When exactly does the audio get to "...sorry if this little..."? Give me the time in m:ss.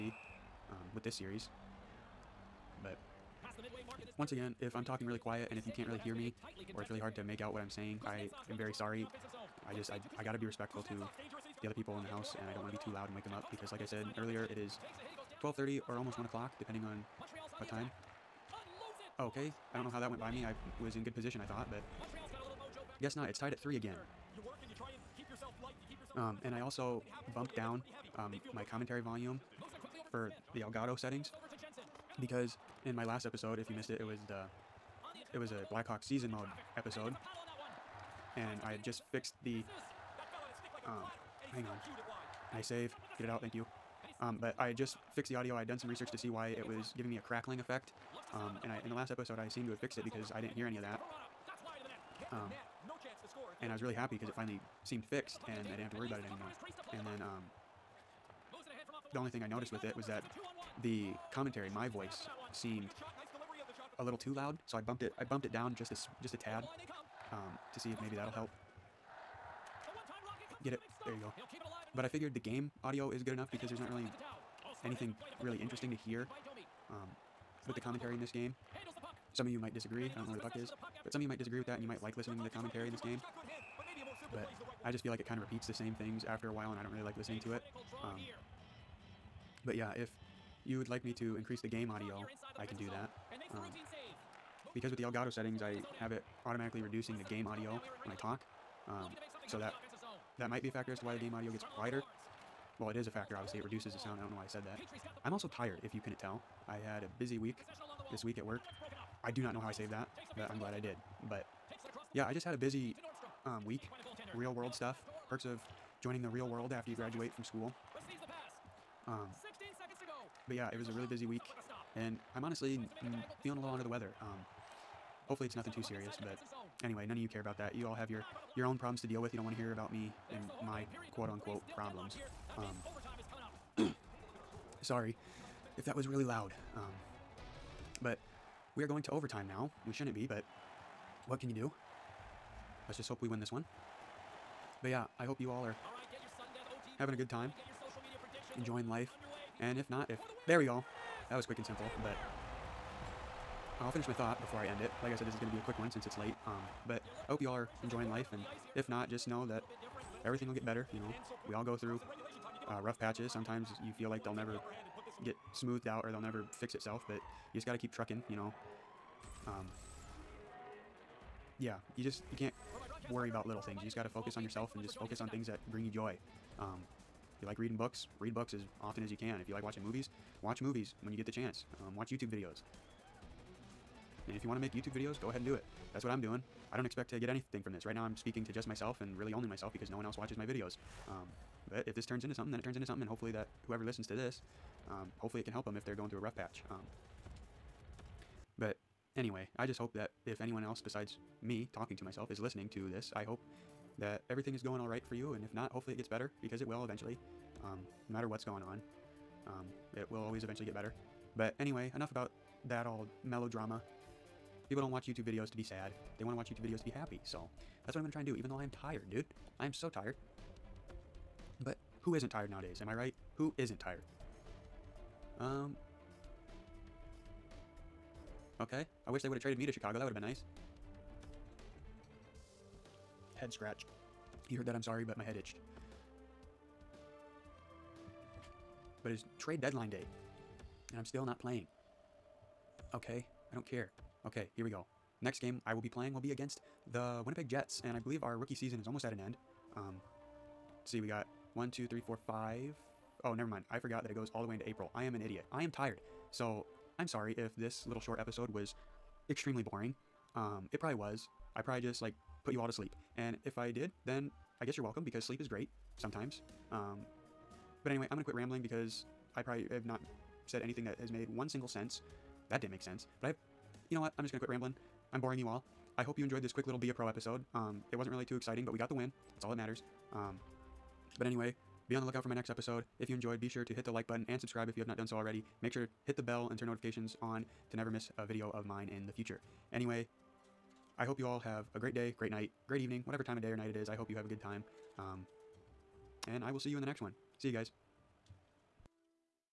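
4:17.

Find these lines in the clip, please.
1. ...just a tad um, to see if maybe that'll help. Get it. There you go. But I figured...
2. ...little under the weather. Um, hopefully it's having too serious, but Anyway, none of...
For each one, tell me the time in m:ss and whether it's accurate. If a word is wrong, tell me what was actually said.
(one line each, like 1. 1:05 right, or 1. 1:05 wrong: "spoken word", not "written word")
1. 1:06 right
2. 2:03 wrong: "nothing", not "having".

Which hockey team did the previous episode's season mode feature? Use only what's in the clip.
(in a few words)
Blackhawk.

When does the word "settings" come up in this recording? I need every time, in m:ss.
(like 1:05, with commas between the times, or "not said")
0:30, 1:35.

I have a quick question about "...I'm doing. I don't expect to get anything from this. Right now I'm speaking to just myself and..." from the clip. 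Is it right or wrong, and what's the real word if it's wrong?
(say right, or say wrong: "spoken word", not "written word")
right.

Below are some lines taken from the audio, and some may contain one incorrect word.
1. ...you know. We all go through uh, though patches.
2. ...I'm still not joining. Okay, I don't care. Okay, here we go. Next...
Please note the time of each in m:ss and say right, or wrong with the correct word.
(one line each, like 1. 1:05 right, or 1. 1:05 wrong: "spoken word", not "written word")
1. 2:40 wrong: "rough", not "though"
2. 4:00 wrong: "playing", not "joining".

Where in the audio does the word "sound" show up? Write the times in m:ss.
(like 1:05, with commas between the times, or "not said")
1:43.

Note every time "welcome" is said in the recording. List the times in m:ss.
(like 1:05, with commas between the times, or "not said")
4:24.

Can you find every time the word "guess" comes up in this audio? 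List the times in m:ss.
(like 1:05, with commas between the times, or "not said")
0:23, 4:24.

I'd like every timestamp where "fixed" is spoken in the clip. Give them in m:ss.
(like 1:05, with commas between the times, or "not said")
0:39, 0:45, 0:49, 0:55.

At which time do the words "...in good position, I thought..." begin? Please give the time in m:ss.
0:20.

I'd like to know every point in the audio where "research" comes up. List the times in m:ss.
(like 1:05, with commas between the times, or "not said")
0:45.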